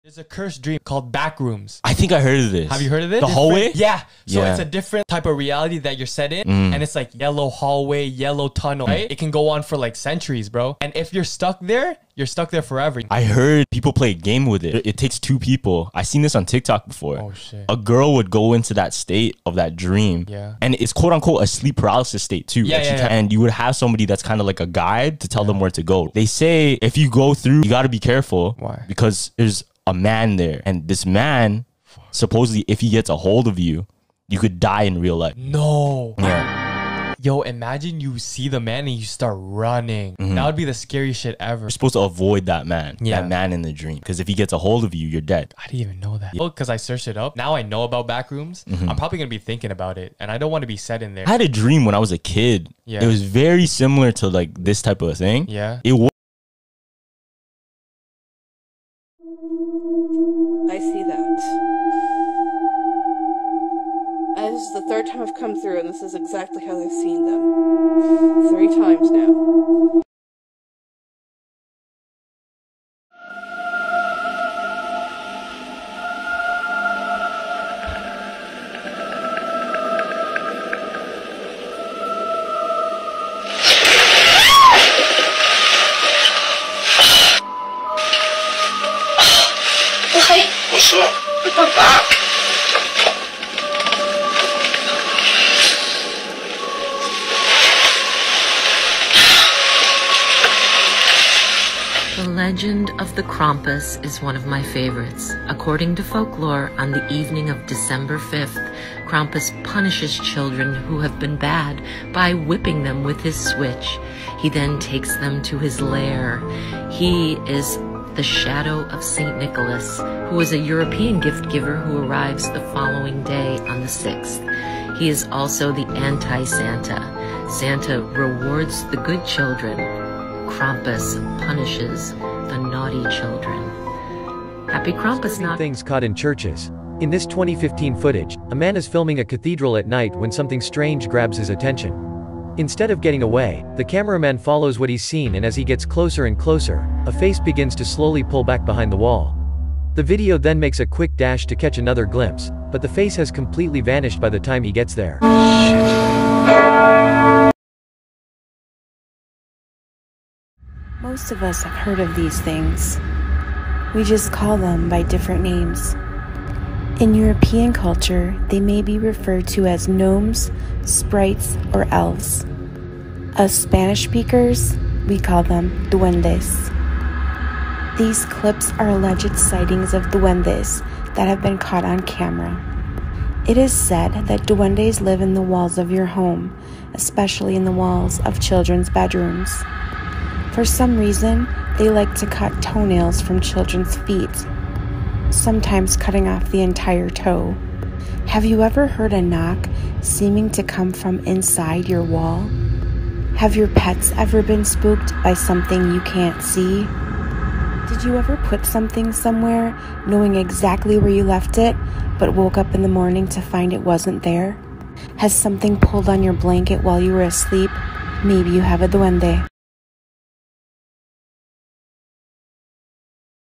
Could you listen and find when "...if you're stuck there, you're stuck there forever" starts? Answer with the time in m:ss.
0:10.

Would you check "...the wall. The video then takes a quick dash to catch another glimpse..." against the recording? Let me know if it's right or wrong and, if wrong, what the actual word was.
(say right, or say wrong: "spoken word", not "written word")
wrong: "makes", not "takes".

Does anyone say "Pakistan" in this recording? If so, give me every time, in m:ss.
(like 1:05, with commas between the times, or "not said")
not said.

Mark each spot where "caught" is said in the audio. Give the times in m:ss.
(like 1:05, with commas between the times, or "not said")
2:15, 3:01.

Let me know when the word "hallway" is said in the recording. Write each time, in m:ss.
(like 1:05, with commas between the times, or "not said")
0:03, 0:07.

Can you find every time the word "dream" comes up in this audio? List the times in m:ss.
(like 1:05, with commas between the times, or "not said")
0:00, 0:19, 0:43, 0:51.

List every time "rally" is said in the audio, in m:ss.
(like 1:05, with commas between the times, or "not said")
not said.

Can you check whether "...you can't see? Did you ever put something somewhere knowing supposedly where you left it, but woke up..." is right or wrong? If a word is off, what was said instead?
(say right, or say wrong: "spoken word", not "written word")
wrong: "exactly", not "supposedly".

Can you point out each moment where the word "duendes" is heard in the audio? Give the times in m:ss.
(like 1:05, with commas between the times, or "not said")
2:55, 3:00, 3:04, 3:38.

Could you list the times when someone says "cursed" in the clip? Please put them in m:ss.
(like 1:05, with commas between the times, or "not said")
0:00.